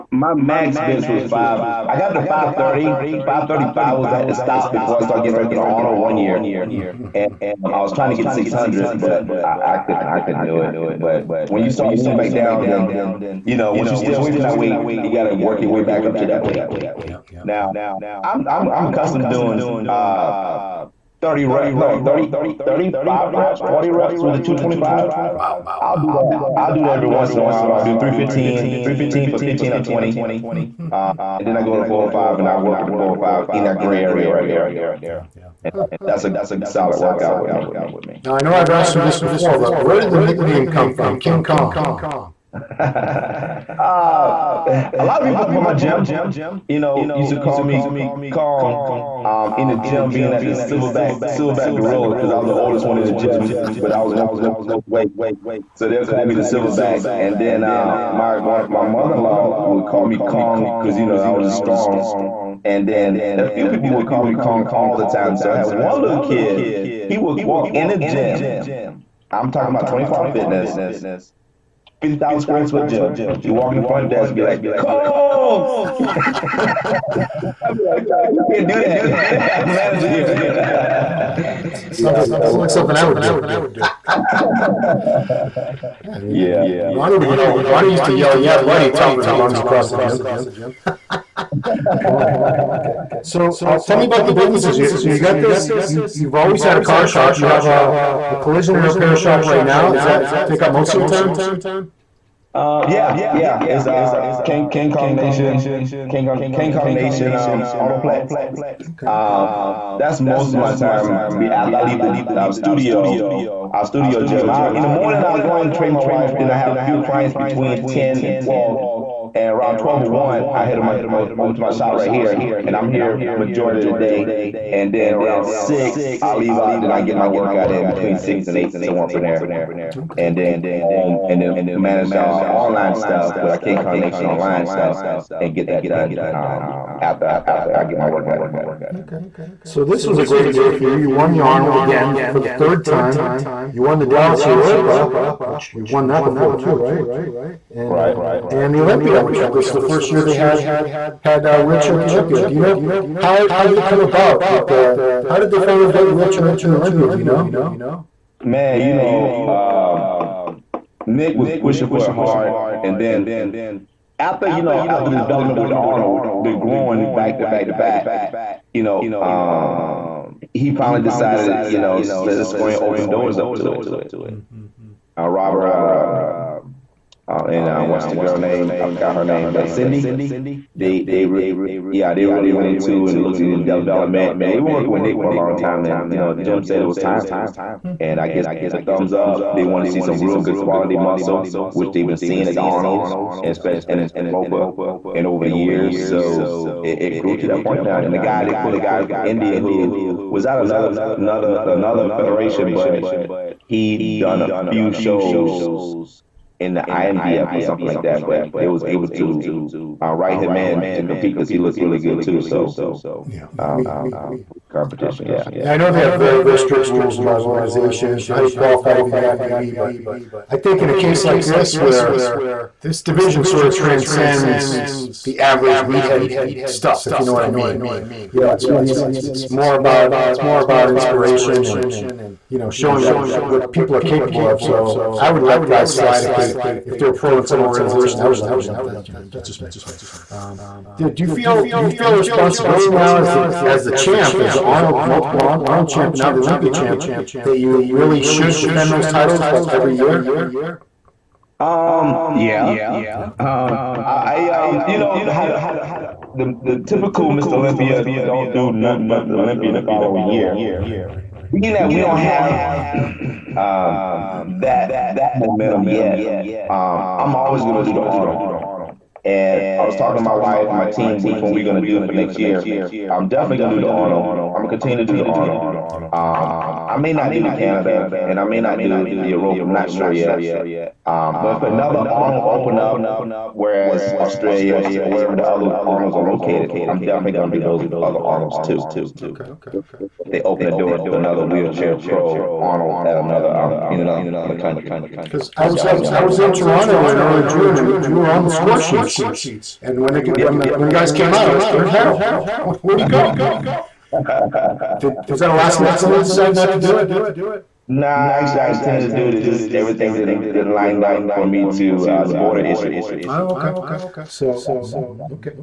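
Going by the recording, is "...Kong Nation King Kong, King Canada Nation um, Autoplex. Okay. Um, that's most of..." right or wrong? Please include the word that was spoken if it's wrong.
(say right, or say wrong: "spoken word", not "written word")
wrong: "Kong", not "Canada".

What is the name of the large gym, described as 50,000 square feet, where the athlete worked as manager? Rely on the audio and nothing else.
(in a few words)
25 Fitness.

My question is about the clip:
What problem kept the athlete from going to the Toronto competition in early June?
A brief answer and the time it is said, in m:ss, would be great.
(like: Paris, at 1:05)
The border issue, at 5:12.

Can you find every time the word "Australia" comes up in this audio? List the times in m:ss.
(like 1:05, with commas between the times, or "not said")
4:44.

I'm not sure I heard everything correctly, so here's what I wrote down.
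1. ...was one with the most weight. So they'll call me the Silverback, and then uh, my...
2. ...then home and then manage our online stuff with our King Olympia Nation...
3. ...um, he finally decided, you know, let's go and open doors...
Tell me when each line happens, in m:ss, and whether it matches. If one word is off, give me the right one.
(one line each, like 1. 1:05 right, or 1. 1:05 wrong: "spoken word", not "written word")
1. 0:54 right
2. 2:10 wrong: "Kong", not "Olympia"
3. 2:49 right.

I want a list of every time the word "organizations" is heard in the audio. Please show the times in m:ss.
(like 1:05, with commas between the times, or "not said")
3:37, 3:57.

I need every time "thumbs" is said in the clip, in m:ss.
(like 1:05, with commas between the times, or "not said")
3:08.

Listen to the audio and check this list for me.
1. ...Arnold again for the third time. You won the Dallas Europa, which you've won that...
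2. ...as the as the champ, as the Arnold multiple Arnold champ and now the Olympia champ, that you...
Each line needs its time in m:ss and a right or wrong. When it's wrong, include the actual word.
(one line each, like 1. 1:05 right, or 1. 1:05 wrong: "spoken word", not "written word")
1. 2:21 right
2. 4:03 right.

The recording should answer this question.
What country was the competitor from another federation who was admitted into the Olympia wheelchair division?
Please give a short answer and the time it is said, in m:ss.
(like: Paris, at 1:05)
India, at 3:19.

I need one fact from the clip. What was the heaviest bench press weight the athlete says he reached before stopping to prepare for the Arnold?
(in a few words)
535.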